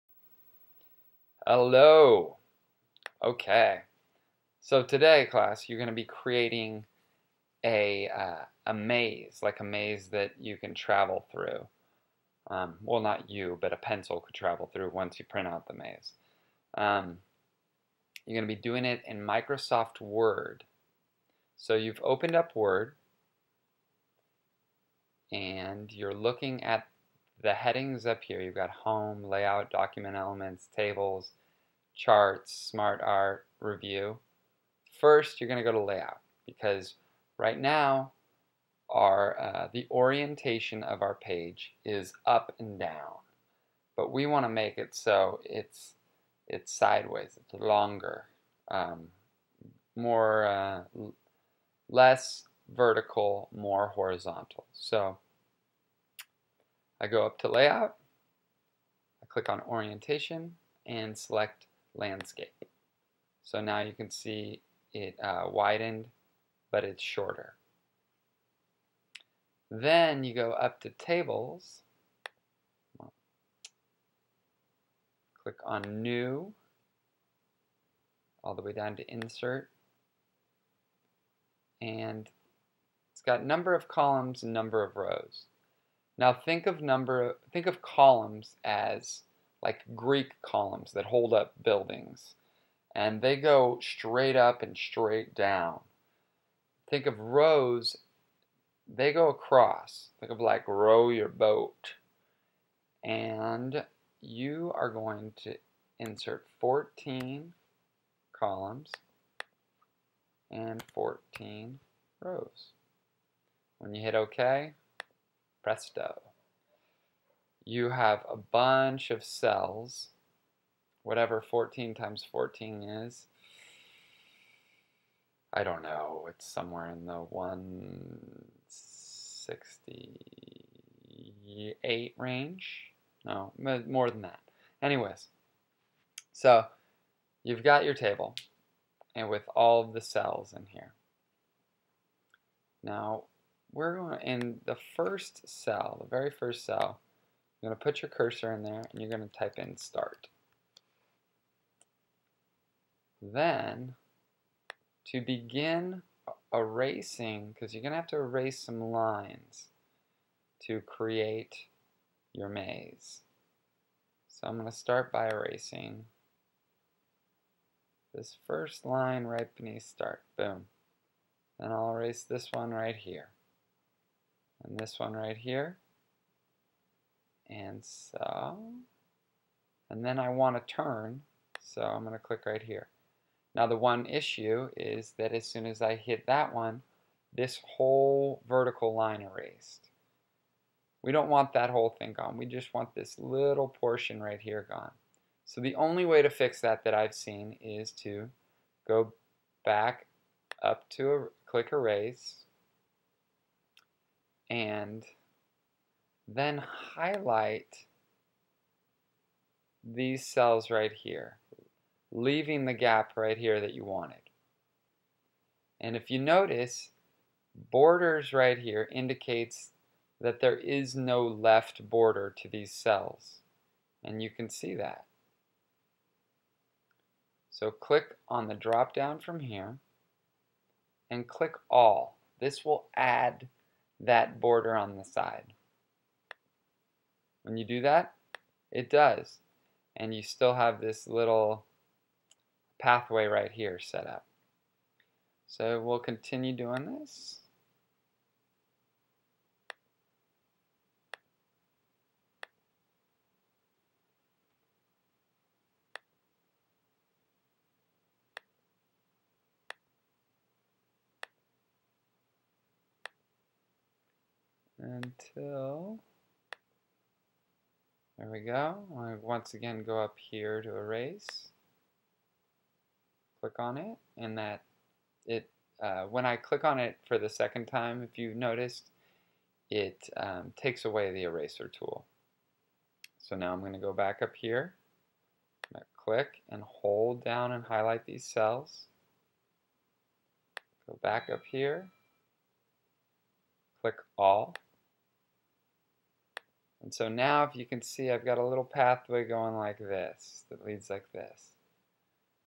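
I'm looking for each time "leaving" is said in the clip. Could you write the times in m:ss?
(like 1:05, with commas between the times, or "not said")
3:32.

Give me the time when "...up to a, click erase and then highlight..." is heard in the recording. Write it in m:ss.
3:20.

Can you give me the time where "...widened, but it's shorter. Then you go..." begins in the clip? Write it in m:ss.
1:05.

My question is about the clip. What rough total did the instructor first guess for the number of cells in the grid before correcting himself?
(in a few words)
168.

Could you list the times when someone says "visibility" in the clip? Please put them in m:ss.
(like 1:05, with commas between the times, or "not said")
not said.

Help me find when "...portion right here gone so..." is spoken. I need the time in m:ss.
3:13.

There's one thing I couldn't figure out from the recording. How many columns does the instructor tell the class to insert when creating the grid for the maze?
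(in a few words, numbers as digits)
14.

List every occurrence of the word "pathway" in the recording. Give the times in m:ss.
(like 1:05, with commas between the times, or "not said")
4:02, 4:58.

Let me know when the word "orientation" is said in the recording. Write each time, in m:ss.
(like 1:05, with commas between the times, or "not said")
0:39, 0:59.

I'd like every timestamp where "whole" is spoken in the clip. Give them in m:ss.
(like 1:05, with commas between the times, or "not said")
3:07, 3:11.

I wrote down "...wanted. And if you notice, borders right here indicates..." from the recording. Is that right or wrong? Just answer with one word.
right.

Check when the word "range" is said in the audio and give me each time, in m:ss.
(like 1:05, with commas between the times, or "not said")
2:12.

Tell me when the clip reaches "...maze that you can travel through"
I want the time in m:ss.
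0:09.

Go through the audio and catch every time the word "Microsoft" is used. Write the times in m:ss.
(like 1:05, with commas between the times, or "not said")
0:19.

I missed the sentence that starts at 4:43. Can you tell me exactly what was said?
So now I'm going to go back up here, click and hold down and highlight these cells.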